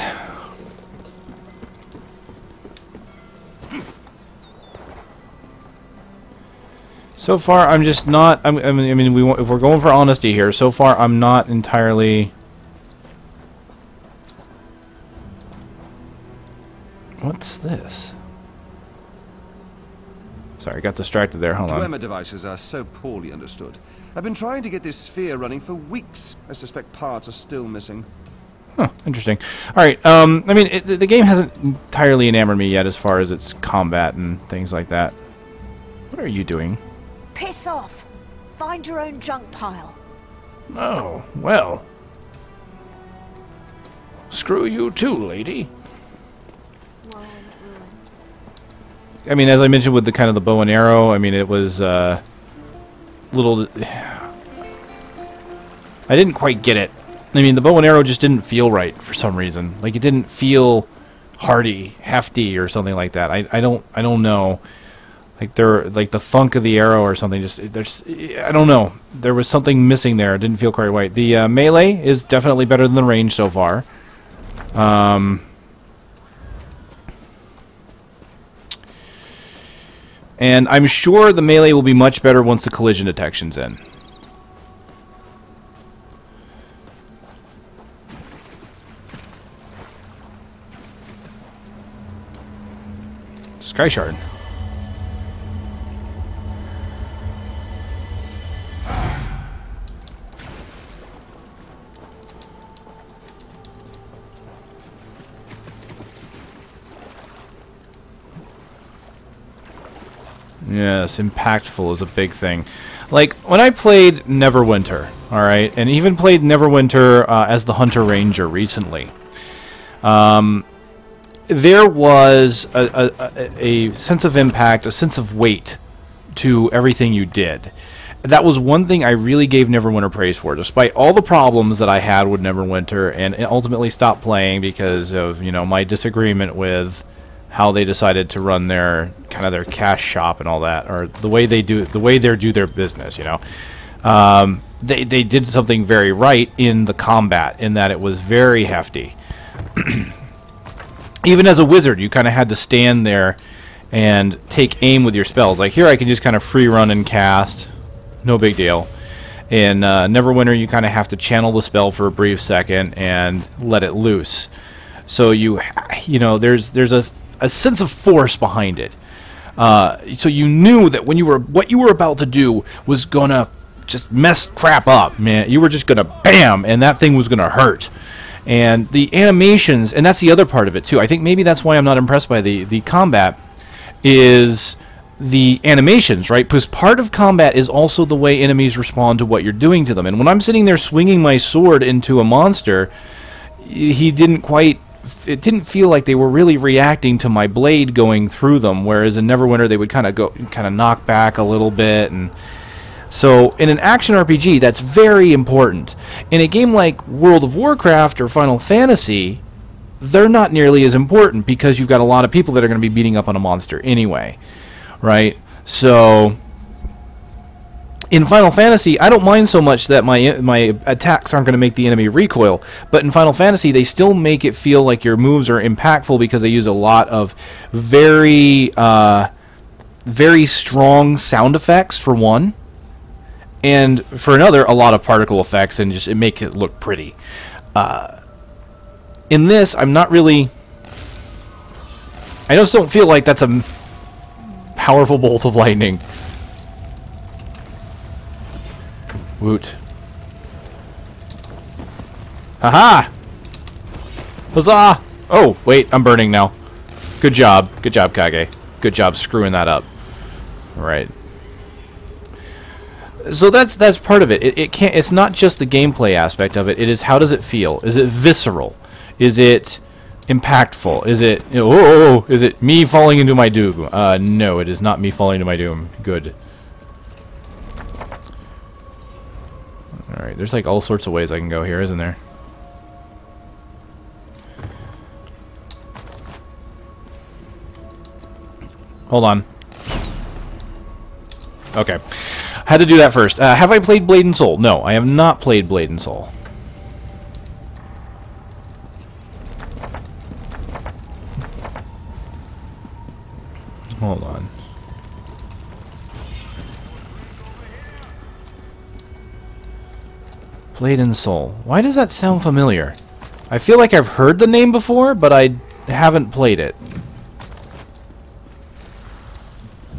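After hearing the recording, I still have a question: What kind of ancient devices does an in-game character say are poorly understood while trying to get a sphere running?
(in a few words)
Dwemer devices.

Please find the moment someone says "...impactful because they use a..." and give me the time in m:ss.
3:45.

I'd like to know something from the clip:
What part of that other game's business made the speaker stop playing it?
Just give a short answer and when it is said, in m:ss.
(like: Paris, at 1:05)
cash shop, at 2:19.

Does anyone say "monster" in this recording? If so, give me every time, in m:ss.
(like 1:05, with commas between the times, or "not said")
3:12, 3:33.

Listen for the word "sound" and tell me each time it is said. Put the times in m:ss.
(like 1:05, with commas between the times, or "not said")
3:51, 5:12.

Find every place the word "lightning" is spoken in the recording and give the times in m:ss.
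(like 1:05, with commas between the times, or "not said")
4:05.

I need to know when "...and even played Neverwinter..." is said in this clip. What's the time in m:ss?
1:55.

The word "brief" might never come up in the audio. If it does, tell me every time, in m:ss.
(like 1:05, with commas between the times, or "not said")
2:42.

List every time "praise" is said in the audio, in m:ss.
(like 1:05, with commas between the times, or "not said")
2:10.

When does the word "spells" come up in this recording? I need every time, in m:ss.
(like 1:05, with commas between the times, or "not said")
2:35, 2:41.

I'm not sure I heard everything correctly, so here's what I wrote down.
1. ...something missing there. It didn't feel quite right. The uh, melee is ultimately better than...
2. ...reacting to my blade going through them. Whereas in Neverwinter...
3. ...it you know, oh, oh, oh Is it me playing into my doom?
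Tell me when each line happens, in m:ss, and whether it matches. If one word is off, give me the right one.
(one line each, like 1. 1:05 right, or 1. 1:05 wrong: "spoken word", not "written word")
1. 1:09 wrong: "definitely", not "ultimately"
2. 3:16 right
3. 4:31 wrong: "falling", not "playing".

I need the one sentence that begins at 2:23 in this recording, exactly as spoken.
You know, um, they they did something very right in the combat in that it was very hefty.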